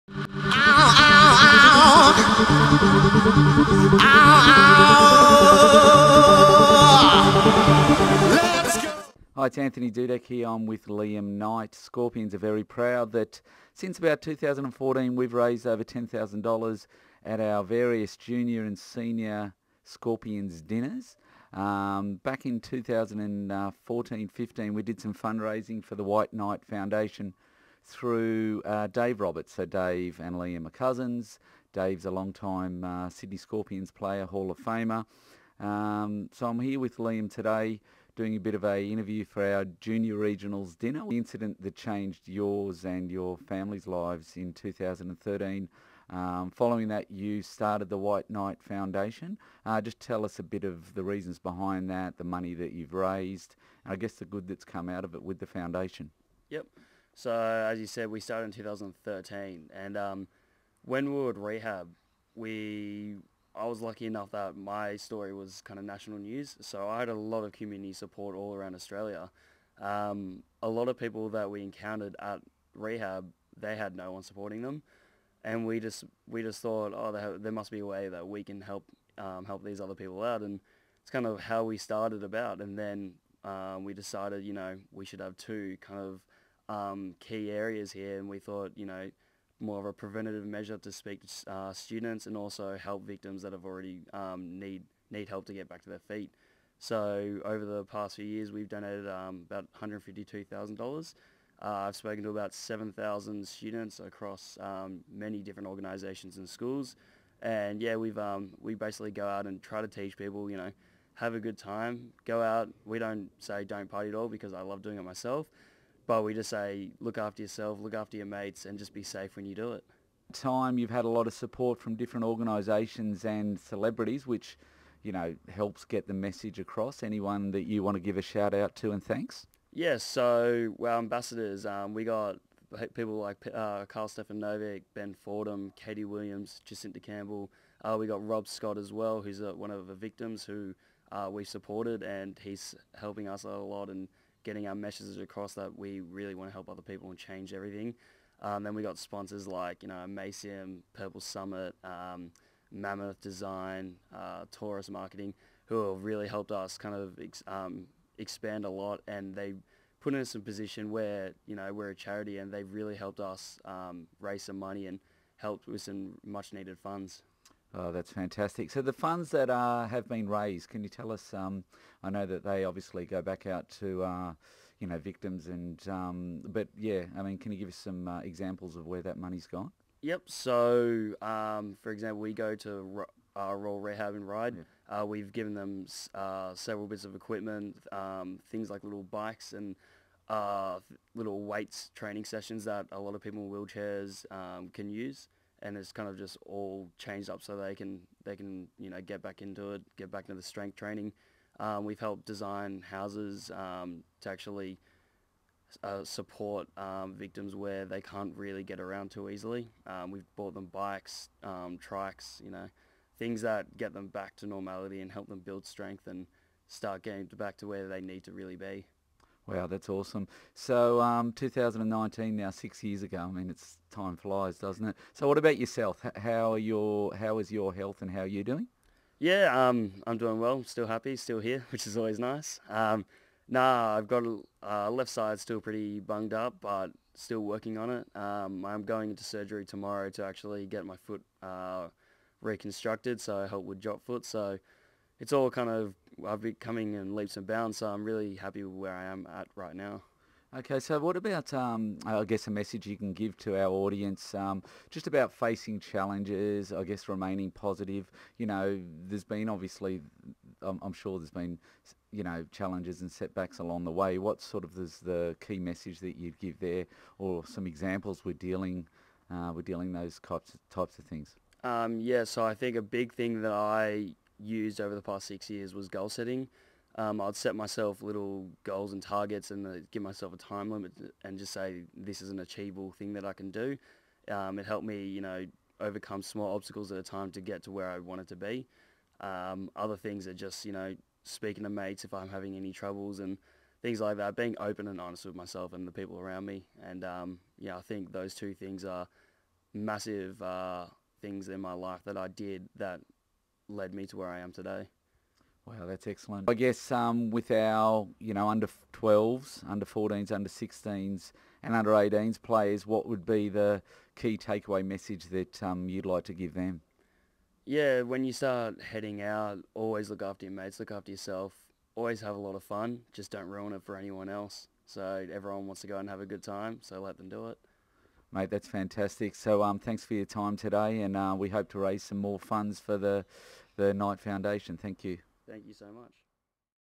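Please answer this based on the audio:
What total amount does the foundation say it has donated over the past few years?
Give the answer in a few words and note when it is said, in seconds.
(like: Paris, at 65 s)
$152,000, at 99 s.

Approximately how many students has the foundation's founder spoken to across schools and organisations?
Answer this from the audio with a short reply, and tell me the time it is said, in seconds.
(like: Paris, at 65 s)
7,000, at 102 s.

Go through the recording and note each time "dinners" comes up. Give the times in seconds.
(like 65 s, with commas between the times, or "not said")
20 s, 40 s.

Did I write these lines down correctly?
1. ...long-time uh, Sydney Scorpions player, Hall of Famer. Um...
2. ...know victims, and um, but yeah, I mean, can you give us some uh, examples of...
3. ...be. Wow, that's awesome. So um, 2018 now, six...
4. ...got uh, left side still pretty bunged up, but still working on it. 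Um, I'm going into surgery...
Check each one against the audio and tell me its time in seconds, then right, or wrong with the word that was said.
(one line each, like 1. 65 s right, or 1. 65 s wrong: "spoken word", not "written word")
1. 32 s right
2. 174 s right
3. 218 s wrong: "2019", not "2018"
4. 234 s right.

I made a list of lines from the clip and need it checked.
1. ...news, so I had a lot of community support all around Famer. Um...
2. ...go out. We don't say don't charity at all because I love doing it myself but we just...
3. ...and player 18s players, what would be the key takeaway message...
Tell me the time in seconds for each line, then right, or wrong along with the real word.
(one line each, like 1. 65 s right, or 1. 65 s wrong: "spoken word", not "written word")
1. 66 s wrong: "Australia", not "Famer"
2. 112 s wrong: "party", not "charity"
3. 311 s wrong: "under", not "player".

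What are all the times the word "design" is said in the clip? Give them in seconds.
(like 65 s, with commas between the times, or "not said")
153 s, 202 s.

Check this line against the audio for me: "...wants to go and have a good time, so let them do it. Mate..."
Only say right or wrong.
right.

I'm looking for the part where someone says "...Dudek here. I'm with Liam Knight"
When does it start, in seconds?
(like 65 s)
9 s.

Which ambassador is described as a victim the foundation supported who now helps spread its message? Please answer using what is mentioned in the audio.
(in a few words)
Rob Scott.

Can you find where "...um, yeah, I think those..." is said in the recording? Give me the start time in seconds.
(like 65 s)
297 s.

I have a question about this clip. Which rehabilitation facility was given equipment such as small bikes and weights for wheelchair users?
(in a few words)
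Royal Rehab.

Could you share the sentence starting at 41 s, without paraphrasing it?
The incident that changed yours and your family's lives in 2013.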